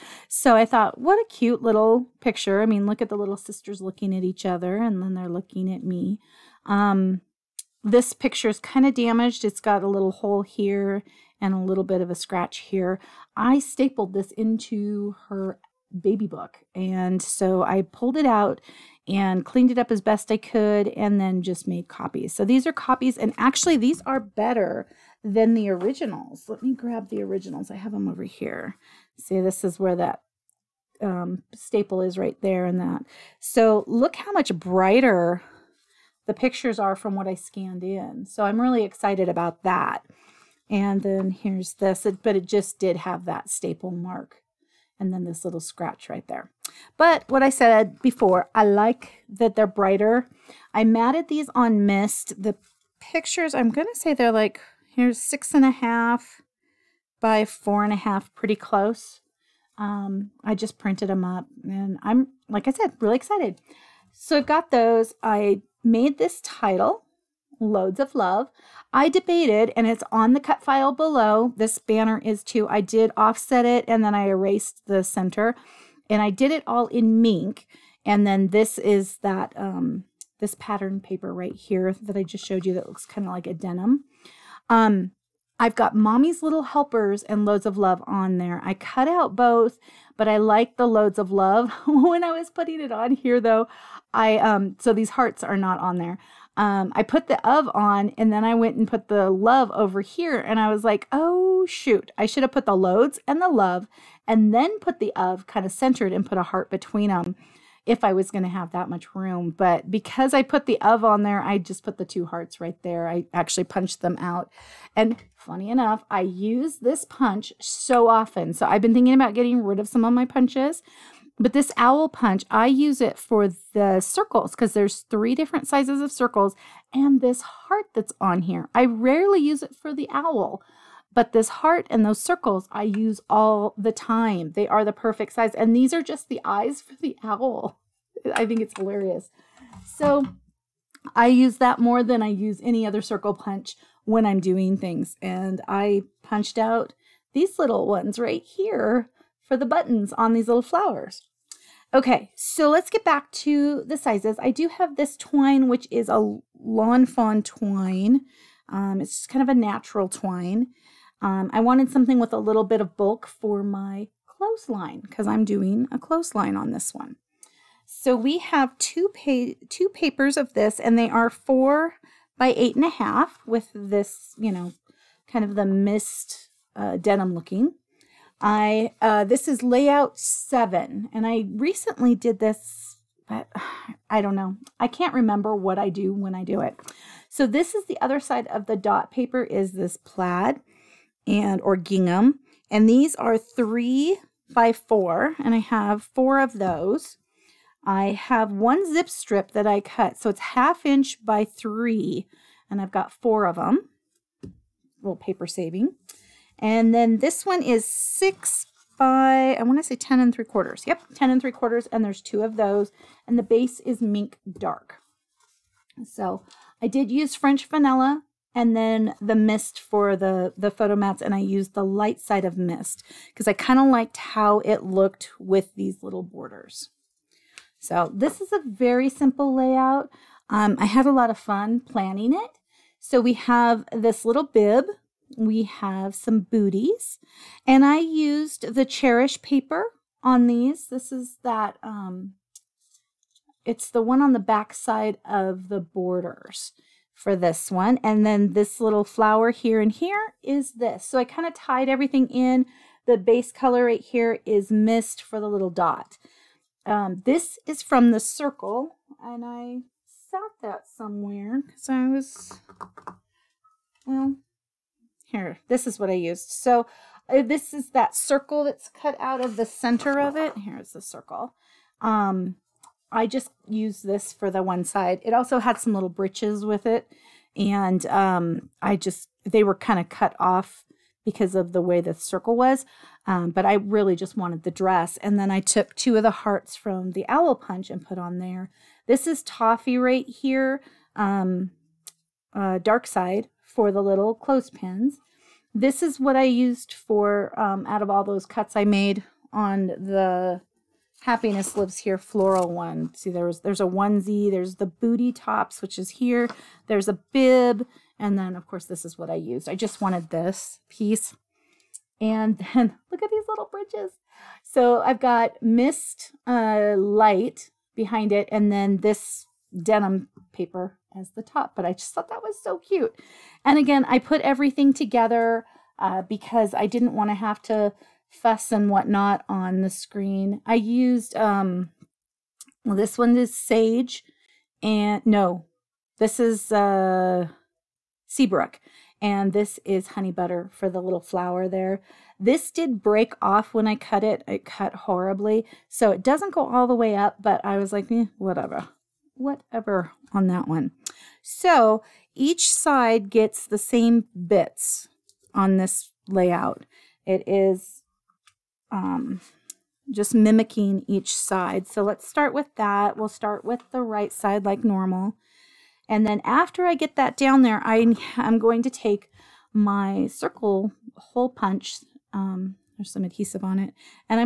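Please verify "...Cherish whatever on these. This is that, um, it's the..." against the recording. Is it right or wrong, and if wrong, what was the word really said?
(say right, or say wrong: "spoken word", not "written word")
wrong: "paper", not "whatever".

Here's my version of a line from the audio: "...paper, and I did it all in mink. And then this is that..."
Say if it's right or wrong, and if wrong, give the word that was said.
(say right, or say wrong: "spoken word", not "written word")
wrong: "center", not "paper".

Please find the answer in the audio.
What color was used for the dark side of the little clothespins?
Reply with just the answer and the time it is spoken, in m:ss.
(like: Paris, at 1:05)
toffee, at 4:49.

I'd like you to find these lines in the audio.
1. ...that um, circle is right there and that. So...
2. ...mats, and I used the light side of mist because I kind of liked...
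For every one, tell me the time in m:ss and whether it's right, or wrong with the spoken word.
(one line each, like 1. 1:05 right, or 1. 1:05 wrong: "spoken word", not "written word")
1. 0:29 wrong: "staple", not "circle"
2. 3:40 right.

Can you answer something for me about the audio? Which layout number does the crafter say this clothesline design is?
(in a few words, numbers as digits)
7.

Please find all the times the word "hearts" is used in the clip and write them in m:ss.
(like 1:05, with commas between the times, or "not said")
1:35, 1:46, 1:52, 2:07, 2:11, 4:46.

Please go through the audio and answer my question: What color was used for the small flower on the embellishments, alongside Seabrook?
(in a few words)
Honey Butter.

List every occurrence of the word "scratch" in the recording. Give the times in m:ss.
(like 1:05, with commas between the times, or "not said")
0:12, 0:45.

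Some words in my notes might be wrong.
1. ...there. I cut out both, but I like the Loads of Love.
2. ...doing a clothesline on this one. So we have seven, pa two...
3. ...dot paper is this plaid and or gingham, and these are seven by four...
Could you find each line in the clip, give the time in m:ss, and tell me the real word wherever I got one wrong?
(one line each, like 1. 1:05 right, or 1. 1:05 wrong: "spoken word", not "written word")
1. 1:28 right
2. 2:45 wrong: "two", not "seven"
3. 3:08 wrong: "three", not "seven".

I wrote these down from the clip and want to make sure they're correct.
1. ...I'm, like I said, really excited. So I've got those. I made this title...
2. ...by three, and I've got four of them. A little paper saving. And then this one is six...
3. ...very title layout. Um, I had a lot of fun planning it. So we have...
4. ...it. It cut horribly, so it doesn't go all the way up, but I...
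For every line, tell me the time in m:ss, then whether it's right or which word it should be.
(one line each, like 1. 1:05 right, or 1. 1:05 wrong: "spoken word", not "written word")
1. 1:02 right
2. 3:21 right
3. 3:48 wrong: "simple", not "title"
4. 5:44 right.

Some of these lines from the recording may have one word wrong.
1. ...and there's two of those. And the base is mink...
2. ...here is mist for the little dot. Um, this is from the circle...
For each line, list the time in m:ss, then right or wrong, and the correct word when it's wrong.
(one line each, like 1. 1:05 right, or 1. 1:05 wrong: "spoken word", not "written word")
1. 3:31 right
2. 4:14 right.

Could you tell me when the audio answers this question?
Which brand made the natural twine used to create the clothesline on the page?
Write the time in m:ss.
2:36.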